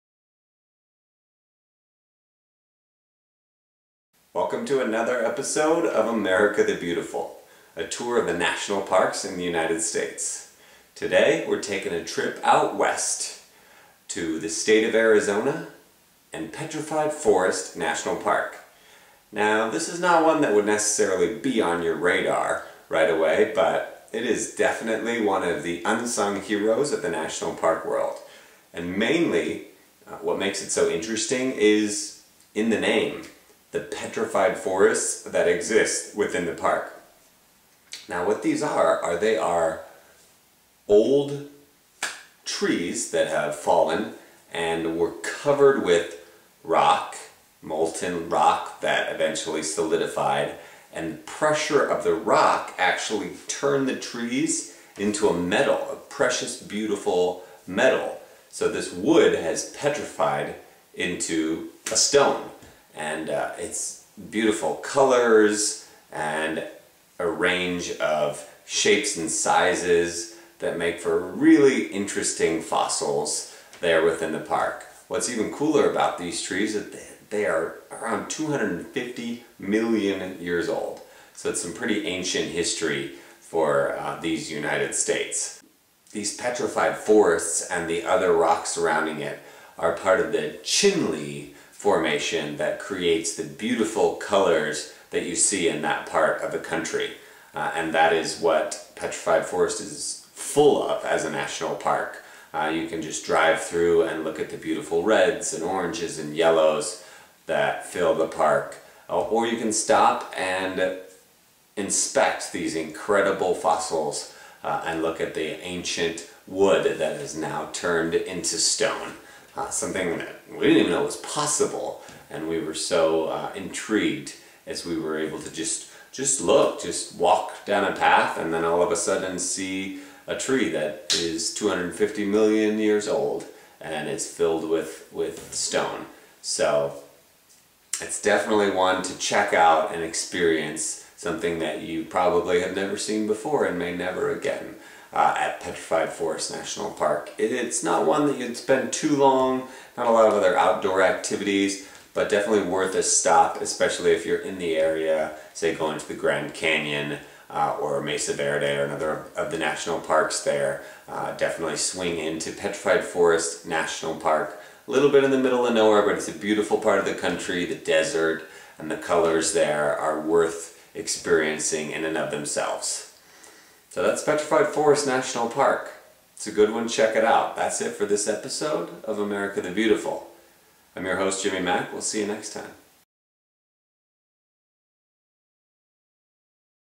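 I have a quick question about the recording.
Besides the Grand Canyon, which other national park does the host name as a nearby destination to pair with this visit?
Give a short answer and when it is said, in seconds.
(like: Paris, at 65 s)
Mesa Verde, at 158 s.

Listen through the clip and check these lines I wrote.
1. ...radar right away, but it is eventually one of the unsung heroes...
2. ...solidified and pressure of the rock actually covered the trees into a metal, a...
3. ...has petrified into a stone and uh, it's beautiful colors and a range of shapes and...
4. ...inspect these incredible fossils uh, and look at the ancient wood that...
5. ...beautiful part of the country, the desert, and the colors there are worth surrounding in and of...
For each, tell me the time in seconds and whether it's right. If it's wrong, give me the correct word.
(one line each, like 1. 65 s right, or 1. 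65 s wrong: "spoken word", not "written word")
1. 21 s wrong: "definitely", not "eventually"
2. 49 s wrong: "turned", not "covered"
3. 59 s right
4. 111 s right
5. 166 s wrong: "experiencing", not "surrounding".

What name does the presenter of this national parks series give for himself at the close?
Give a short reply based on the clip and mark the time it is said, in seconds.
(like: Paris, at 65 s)
Jimmy Mack, at 181 s.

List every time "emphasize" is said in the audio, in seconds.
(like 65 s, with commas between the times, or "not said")
not said.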